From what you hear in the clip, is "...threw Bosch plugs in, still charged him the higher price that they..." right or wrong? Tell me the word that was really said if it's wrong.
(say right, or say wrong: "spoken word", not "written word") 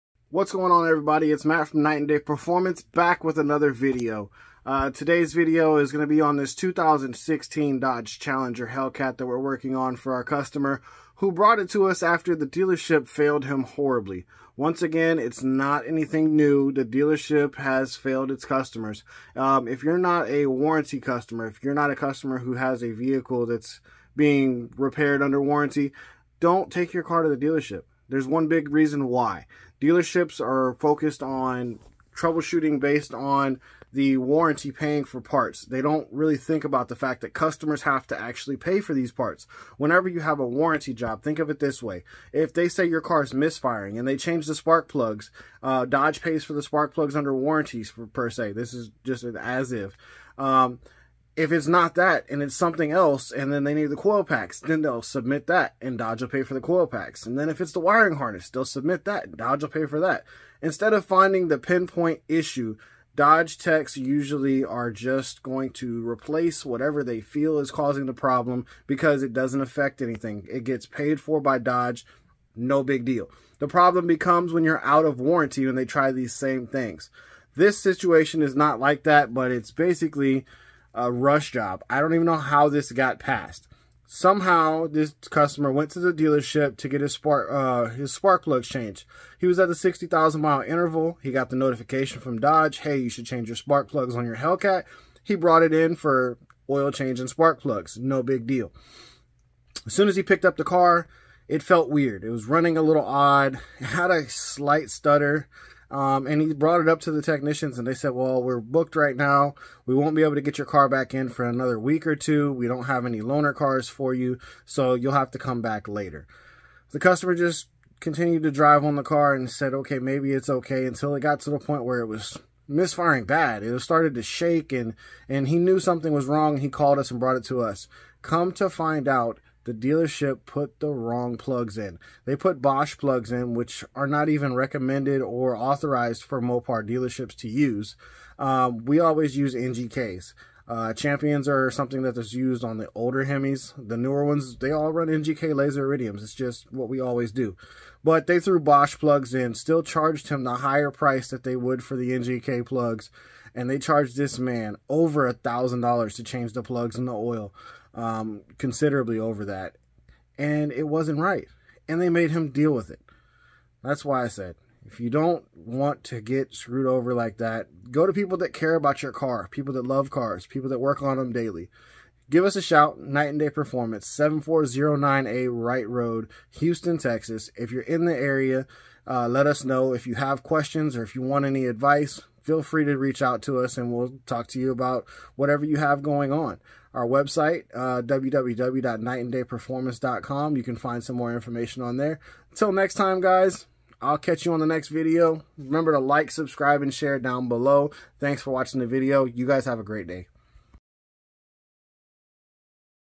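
right.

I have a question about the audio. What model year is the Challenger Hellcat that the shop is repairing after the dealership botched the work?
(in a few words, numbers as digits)
2016.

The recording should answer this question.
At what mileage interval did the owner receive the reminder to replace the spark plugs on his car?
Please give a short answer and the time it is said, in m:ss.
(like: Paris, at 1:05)
60,000 miles, at 1:29.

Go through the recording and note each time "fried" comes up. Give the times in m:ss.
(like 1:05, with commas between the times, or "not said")
not said.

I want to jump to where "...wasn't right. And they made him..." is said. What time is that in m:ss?
2:40.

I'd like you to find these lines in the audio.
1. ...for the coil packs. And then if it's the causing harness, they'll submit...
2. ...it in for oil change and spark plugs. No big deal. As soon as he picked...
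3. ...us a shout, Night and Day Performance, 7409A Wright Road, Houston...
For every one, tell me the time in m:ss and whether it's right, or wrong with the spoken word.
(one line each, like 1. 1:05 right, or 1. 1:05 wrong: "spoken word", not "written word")
1. 0:56 wrong: "wiring", not "causing"
2. 1:35 right
3. 2:52 right.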